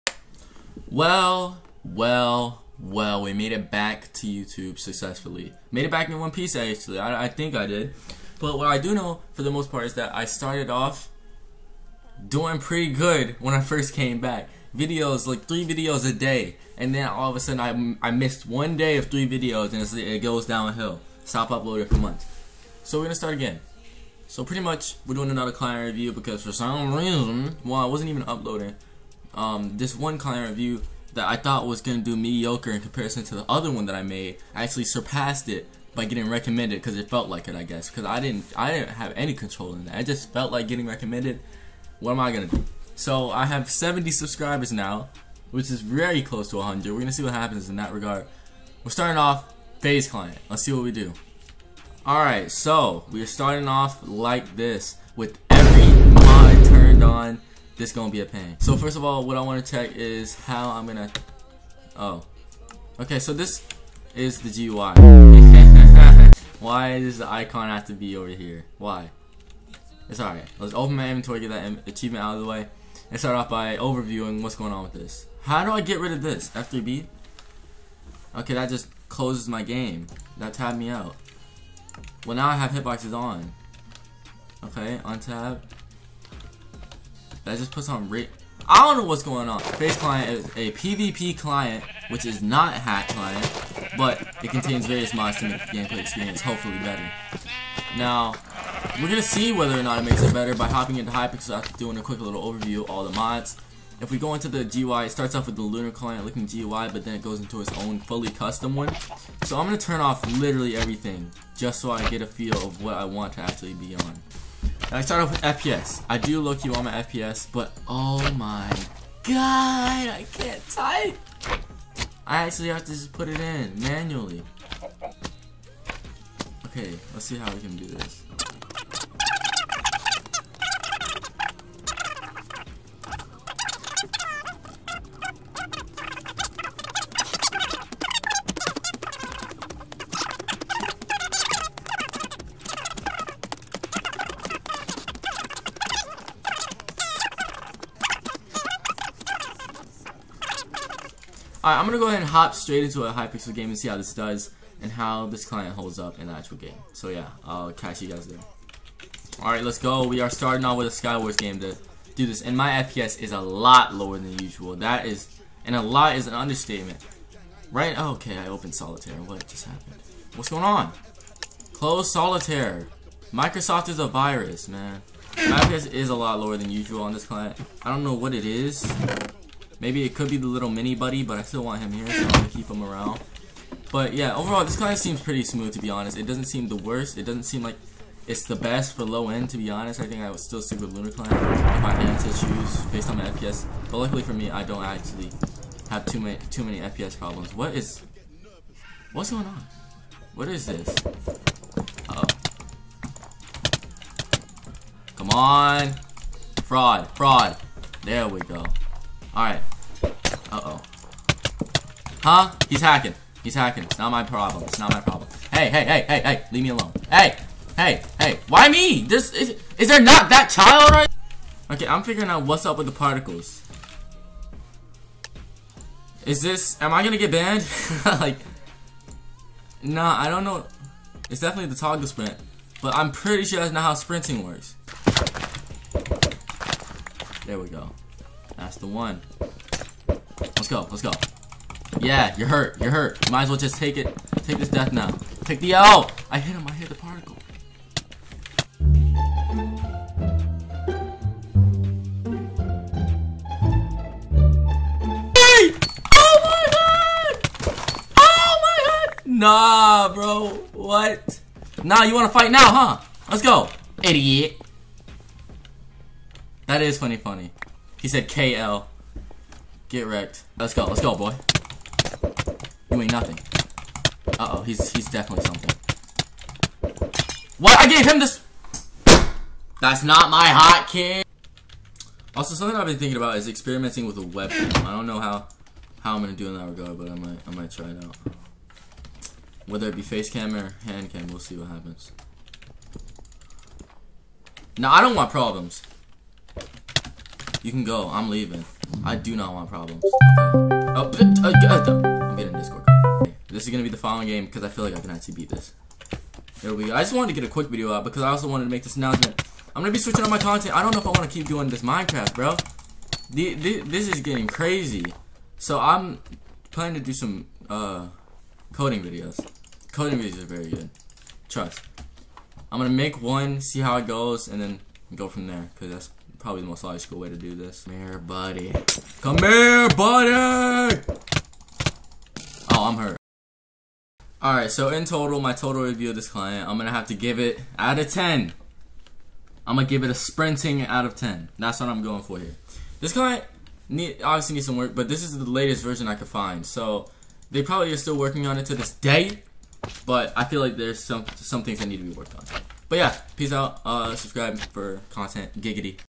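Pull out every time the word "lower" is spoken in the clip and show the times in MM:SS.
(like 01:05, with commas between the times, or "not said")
02:43, 02:56.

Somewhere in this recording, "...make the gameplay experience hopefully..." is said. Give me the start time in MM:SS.
01:35.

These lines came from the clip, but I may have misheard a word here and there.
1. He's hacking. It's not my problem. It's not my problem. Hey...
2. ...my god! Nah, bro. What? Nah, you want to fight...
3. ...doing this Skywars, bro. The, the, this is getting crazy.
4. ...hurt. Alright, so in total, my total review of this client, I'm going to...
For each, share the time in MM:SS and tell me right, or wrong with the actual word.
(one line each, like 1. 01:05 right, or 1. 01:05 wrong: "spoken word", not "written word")
1. 03:33 right
2. 04:18 right
3. 05:11 wrong: "Minecraft", not "Skywars"
4. 05:32 right.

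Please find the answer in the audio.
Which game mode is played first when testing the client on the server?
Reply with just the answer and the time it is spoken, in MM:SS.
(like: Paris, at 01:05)
Skywars, at 02:40.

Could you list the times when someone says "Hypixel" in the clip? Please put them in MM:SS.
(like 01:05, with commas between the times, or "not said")
01:41, 02:33.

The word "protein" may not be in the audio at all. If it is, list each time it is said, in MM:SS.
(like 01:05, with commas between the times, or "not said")
not said.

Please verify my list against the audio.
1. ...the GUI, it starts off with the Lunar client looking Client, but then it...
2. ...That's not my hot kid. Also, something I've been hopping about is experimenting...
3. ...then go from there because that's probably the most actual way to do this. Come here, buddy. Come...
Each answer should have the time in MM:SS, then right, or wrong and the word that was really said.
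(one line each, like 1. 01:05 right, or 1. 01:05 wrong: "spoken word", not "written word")
1. 01:44 wrong: "GUI", not "Client"
2. 04:39 wrong: "thinking", not "hopping"
3. 05:24 wrong: "logical", not "actual".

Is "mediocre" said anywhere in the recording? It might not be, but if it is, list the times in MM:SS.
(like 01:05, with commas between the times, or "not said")
00:32.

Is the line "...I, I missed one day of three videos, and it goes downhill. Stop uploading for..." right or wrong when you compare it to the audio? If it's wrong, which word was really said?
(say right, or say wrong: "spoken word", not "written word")
right.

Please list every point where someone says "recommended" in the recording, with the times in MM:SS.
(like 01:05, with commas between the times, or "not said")
00:36, 00:40.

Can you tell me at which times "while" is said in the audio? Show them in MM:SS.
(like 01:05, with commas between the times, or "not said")
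00:27.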